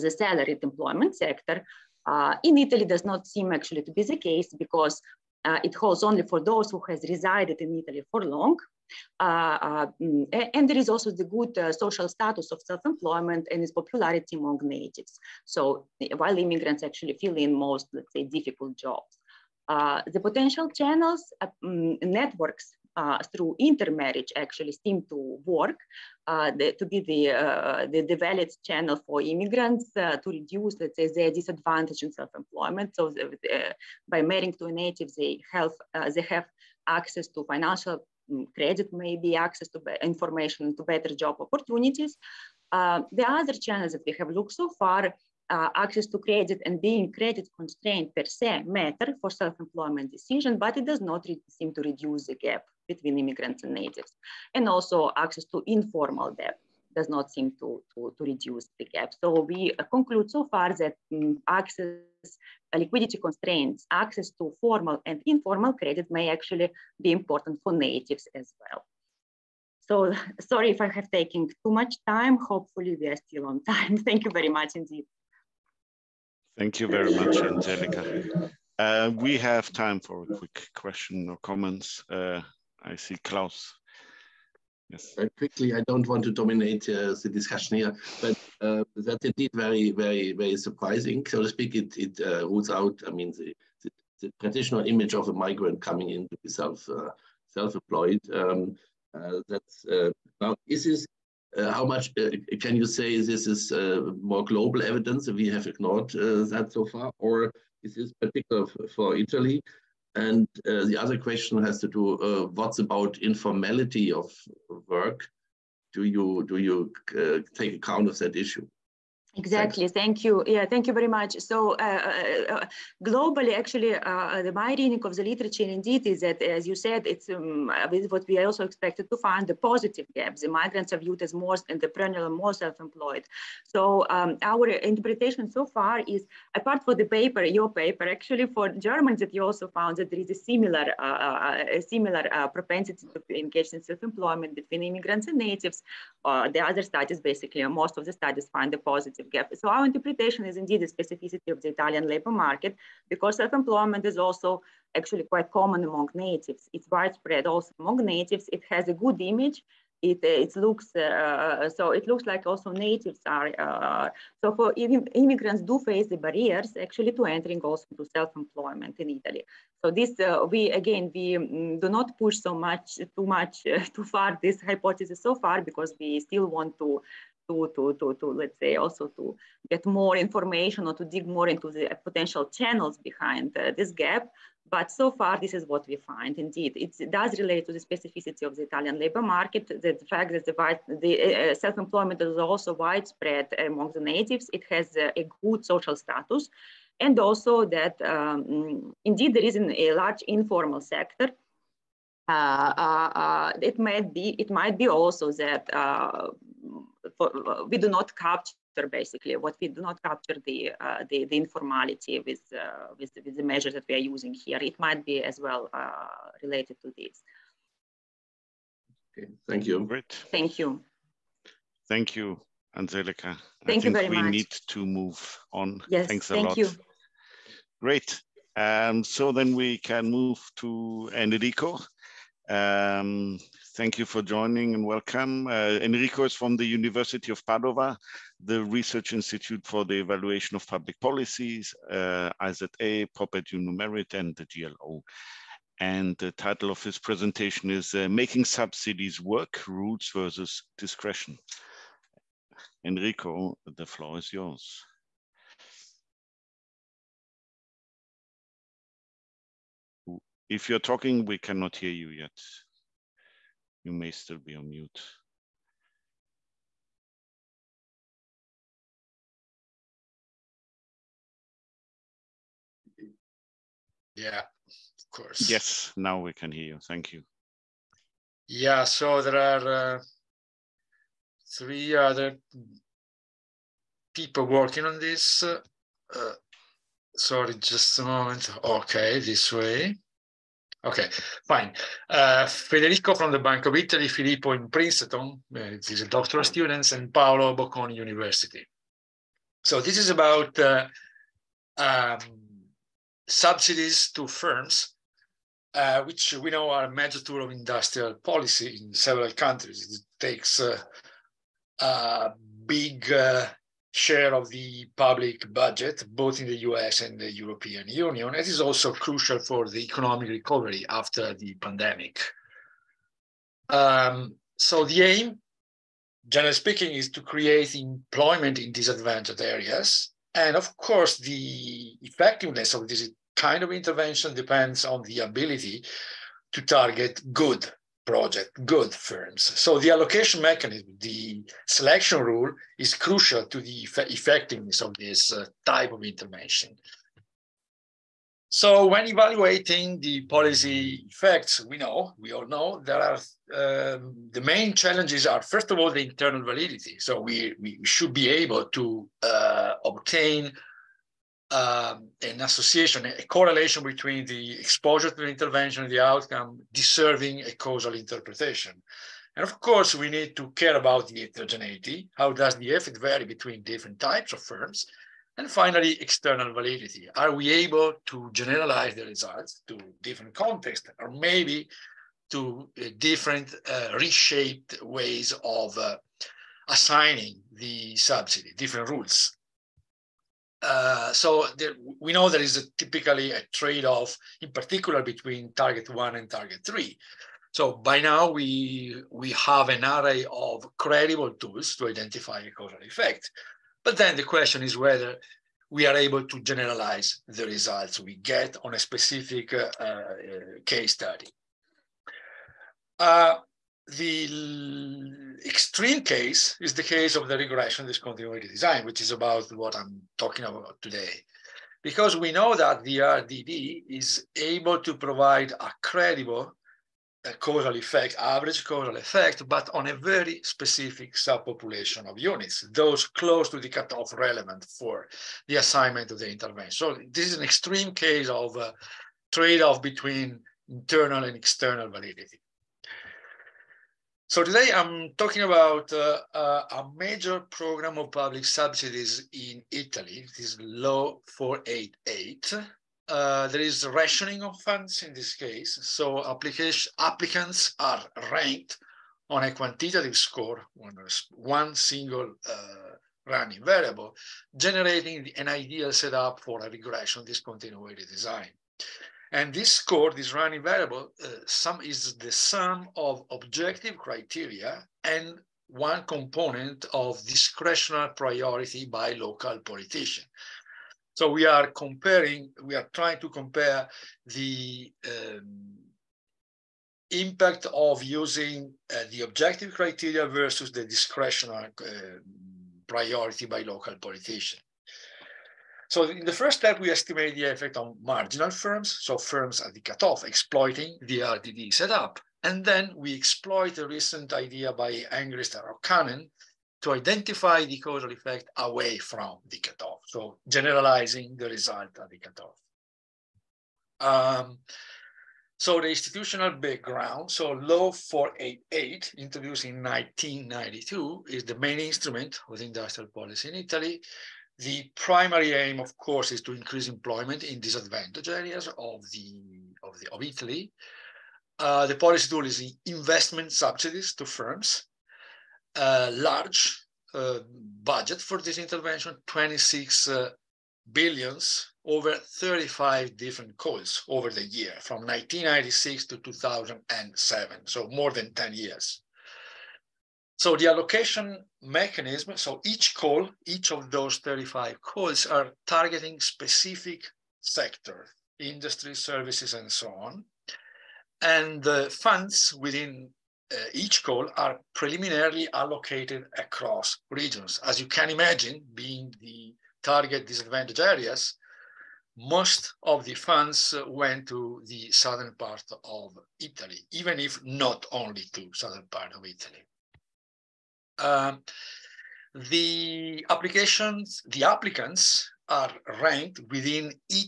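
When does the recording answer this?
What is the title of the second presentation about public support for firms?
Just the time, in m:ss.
4:08.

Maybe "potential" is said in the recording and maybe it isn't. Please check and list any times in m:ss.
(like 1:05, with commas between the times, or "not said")
0:20, 3:02.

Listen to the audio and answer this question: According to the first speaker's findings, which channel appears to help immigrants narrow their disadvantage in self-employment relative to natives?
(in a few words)
Intermarriage.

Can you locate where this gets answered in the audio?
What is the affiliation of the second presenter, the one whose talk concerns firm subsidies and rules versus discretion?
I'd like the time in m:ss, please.
3:56.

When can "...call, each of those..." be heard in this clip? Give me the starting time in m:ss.
9:12.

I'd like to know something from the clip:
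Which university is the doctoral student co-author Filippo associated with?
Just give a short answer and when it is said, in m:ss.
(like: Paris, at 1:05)
Princeton, at 4:54.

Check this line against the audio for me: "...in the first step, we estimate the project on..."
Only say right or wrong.
wrong.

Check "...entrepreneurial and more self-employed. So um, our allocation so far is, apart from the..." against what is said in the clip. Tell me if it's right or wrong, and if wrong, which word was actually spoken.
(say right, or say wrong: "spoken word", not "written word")
wrong: "interpretation", not "allocation".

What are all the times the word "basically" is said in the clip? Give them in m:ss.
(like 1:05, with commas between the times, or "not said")
2:27, 3:28.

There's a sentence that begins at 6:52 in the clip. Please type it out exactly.
Uh, the extreme case is the case of the regression discontinuity design, which is about what I'm talking about today.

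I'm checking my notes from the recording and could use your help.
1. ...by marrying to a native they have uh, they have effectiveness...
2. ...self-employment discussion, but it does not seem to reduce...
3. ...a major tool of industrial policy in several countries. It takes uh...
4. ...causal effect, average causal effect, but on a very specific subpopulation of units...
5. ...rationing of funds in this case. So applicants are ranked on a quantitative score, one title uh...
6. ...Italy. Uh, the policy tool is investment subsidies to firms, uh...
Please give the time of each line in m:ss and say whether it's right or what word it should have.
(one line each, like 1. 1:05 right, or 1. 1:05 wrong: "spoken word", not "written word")
1. 0:34 wrong: "access", not "effectiveness"
2. 0:49 wrong: "decision", not "discussion"
3. 5:06 right
4. 7:07 right
5. 7:33 wrong: "single", not "title"
6. 8:50 right.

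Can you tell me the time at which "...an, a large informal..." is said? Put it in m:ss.
3:19.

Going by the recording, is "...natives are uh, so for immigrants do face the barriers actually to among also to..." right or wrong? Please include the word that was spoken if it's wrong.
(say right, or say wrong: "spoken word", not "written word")
wrong: "entering", not "among".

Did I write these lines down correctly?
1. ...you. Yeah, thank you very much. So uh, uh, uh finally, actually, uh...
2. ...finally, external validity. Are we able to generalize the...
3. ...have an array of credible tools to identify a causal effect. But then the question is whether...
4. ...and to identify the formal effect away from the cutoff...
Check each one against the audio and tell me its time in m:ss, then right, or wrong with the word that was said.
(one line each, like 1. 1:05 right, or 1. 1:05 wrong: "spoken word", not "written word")
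1. 2:00 wrong: "globally", not "finally"
2. 6:15 right
3. 6:39 right
4. 8:26 wrong: "causal", not "formal".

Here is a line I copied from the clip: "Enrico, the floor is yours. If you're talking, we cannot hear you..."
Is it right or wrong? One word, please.
right.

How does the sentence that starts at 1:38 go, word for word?
Um, uh, that's uh, now is this uh, how much uh, can you say this is uh, more global evidence?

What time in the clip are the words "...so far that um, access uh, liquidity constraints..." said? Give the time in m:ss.
1:00.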